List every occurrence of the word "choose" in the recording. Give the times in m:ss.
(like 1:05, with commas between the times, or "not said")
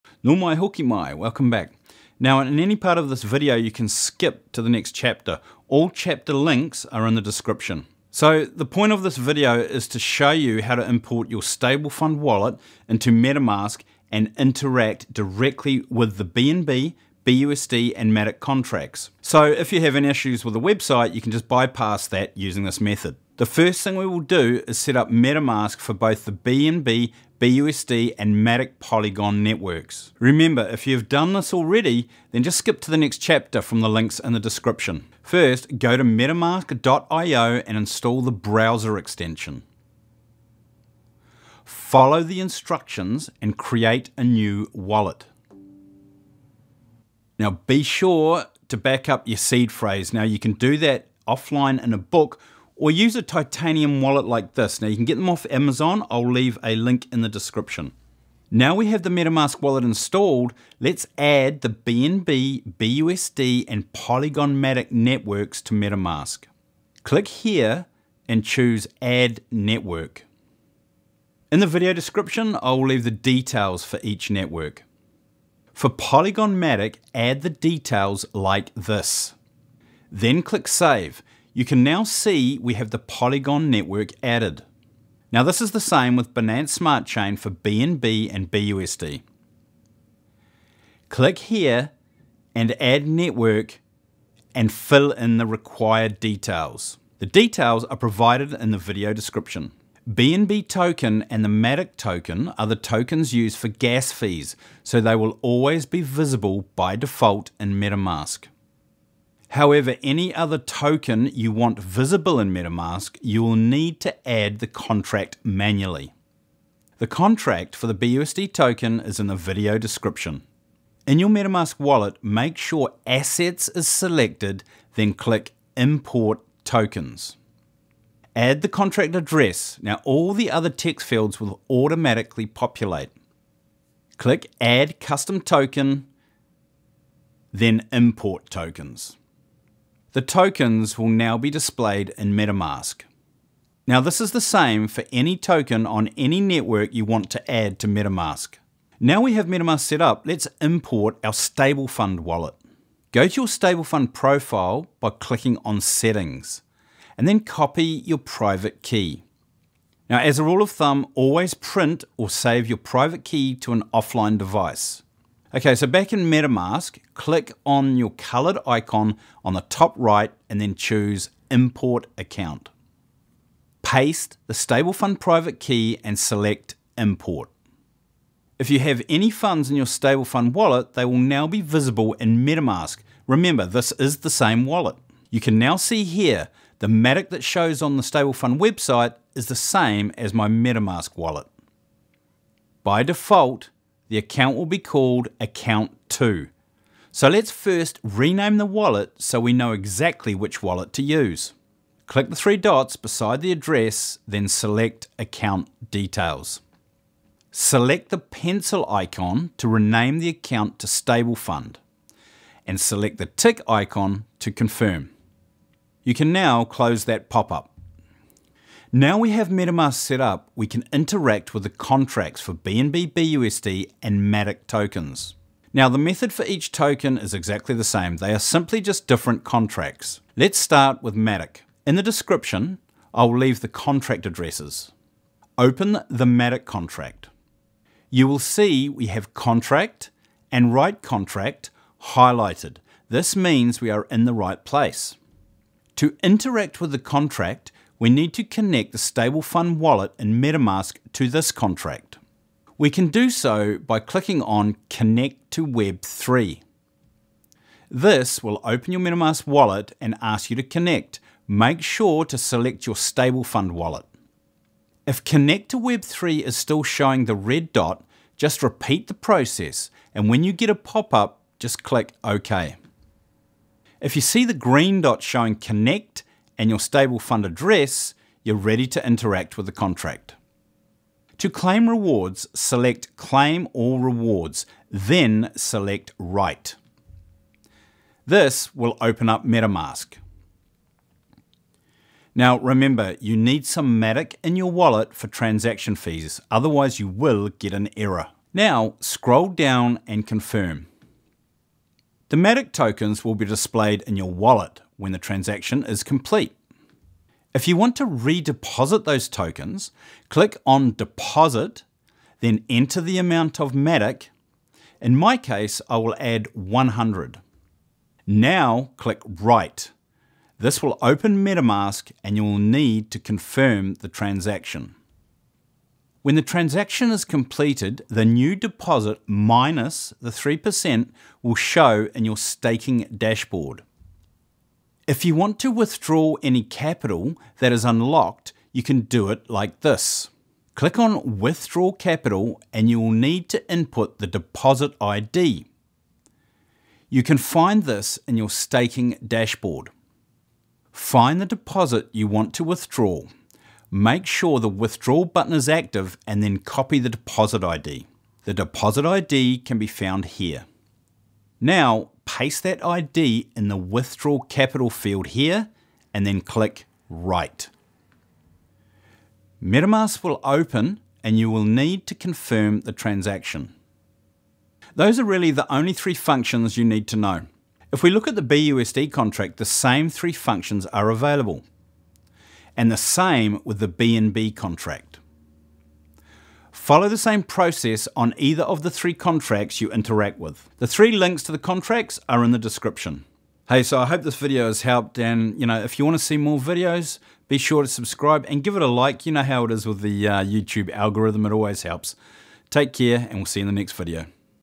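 1:08, 2:50.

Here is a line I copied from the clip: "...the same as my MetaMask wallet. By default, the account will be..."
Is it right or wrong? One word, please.
right.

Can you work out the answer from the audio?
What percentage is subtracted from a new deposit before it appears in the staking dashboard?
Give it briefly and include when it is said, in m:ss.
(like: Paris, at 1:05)
3%, at 5:30.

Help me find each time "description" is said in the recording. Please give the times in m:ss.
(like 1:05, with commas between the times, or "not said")
0:07, 0:34, 0:57, 1:11, 1:39, 1:59, 3:52, 6:32.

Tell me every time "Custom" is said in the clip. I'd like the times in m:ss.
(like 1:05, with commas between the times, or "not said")
2:15.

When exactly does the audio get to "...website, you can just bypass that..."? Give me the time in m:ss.
0:20.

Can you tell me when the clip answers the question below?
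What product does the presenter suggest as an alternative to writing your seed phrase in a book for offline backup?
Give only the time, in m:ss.
0:53.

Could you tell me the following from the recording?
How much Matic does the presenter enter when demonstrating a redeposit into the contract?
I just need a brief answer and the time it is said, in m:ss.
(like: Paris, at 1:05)
100, at 5:16.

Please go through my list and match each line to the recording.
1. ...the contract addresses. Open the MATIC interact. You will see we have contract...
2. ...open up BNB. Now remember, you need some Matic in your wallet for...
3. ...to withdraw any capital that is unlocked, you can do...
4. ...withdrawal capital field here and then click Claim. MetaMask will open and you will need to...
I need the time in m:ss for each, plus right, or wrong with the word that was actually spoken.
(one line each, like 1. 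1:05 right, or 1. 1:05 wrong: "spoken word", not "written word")
1. 3:53 wrong: "contract", not "interact"
2. 4:49 wrong: "MetaMask", not "BNB"
3. 5:35 right
4. 6:03 wrong: "Write", not "Claim".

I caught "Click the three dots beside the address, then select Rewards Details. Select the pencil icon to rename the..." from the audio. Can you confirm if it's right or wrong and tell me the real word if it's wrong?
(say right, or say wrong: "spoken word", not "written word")
wrong: "Account", not "Rewards".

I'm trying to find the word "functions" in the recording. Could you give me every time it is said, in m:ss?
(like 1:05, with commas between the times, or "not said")
6:16, 6:20.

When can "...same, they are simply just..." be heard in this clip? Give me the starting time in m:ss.
3:47.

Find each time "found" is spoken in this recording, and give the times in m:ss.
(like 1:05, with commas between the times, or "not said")
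5:59.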